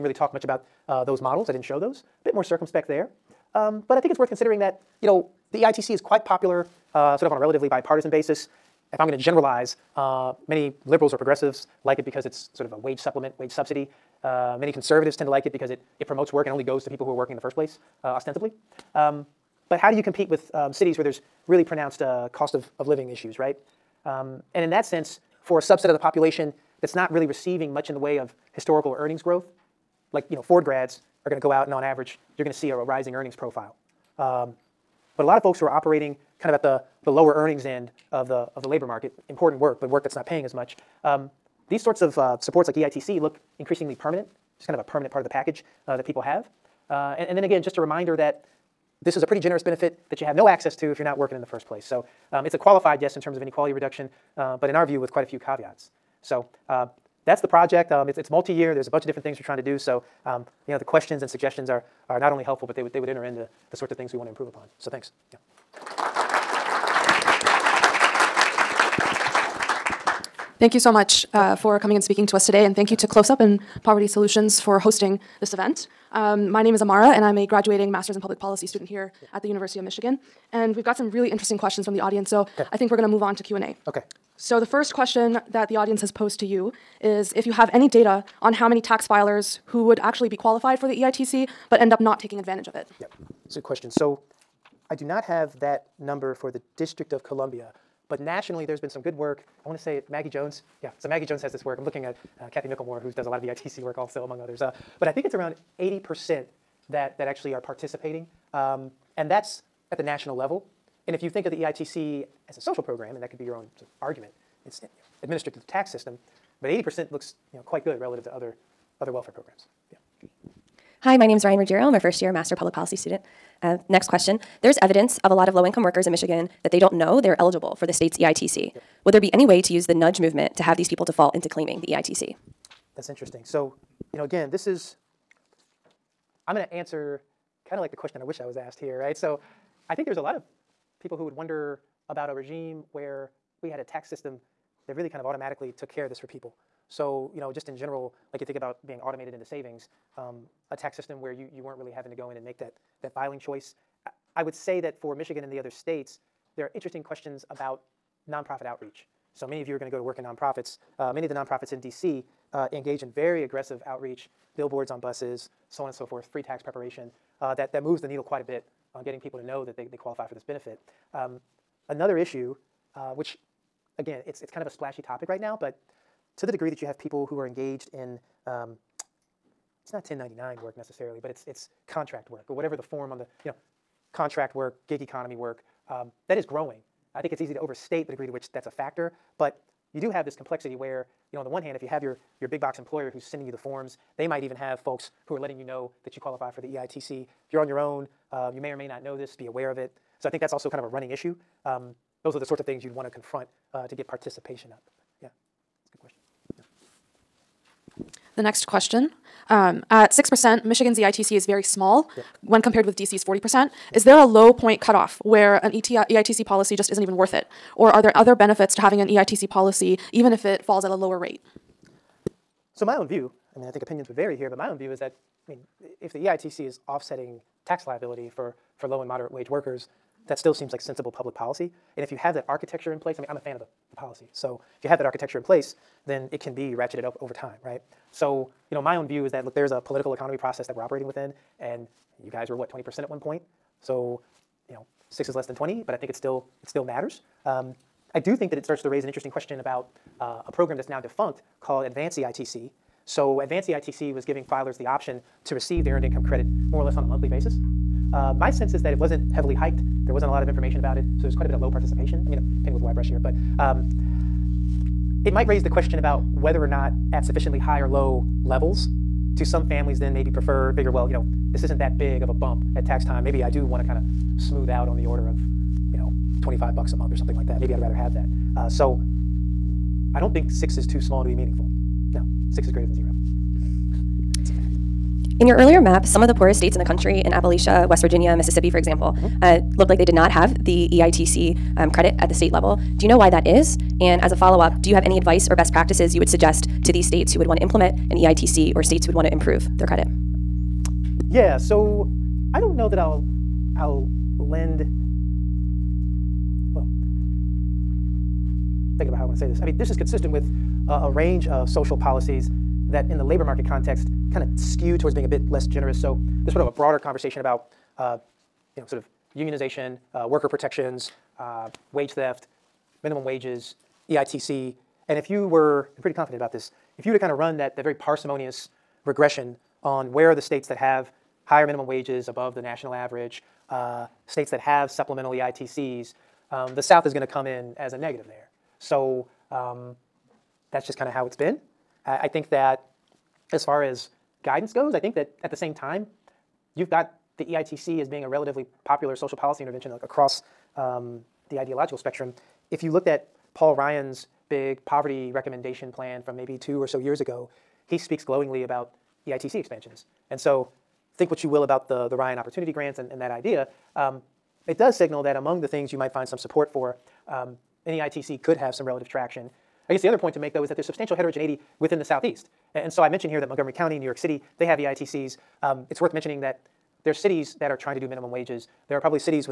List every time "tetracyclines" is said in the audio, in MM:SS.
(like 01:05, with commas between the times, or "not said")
not said.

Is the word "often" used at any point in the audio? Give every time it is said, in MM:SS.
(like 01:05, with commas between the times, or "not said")
not said.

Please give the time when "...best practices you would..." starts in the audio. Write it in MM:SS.
04:55.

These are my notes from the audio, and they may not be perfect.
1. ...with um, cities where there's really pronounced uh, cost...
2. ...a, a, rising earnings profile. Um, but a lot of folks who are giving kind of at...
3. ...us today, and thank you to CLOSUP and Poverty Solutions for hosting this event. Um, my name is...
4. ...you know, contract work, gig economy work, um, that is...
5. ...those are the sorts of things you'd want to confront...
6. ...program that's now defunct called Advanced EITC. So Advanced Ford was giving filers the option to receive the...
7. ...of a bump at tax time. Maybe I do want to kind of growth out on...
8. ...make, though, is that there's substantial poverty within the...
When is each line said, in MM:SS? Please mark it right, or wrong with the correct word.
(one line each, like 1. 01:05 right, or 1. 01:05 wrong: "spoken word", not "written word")
1. 00:20 right
2. 00:32 wrong: "operating", not "giving"
3. 01:12 right
4. 03:03 right
5. 03:22 right
6. 04:10 wrong: "EITC", not "Ford"
7. 04:32 wrong: "smooth", not "growth"
8. 06:10 wrong: "heterogeneity", not "poverty".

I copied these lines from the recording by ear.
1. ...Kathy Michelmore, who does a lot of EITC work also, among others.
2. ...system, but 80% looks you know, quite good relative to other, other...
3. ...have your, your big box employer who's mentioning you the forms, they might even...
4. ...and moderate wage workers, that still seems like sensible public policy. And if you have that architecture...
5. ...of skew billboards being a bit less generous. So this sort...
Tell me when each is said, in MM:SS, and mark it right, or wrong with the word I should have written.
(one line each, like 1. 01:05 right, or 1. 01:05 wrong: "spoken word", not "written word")
1. 01:42 right
2. 01:55 right
3. 03:11 wrong: "sending", not "mentioning"
4. 03:49 right
5. 05:14 wrong: "towards", not "billboards".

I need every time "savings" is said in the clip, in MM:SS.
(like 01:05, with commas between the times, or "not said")
02:29.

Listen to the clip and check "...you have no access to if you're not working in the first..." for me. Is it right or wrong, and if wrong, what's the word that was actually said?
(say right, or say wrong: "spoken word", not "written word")
right.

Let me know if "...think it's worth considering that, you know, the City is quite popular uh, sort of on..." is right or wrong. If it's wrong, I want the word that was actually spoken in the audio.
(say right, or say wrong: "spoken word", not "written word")
wrong: "EITC", not "City".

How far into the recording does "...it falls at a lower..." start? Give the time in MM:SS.
03:40.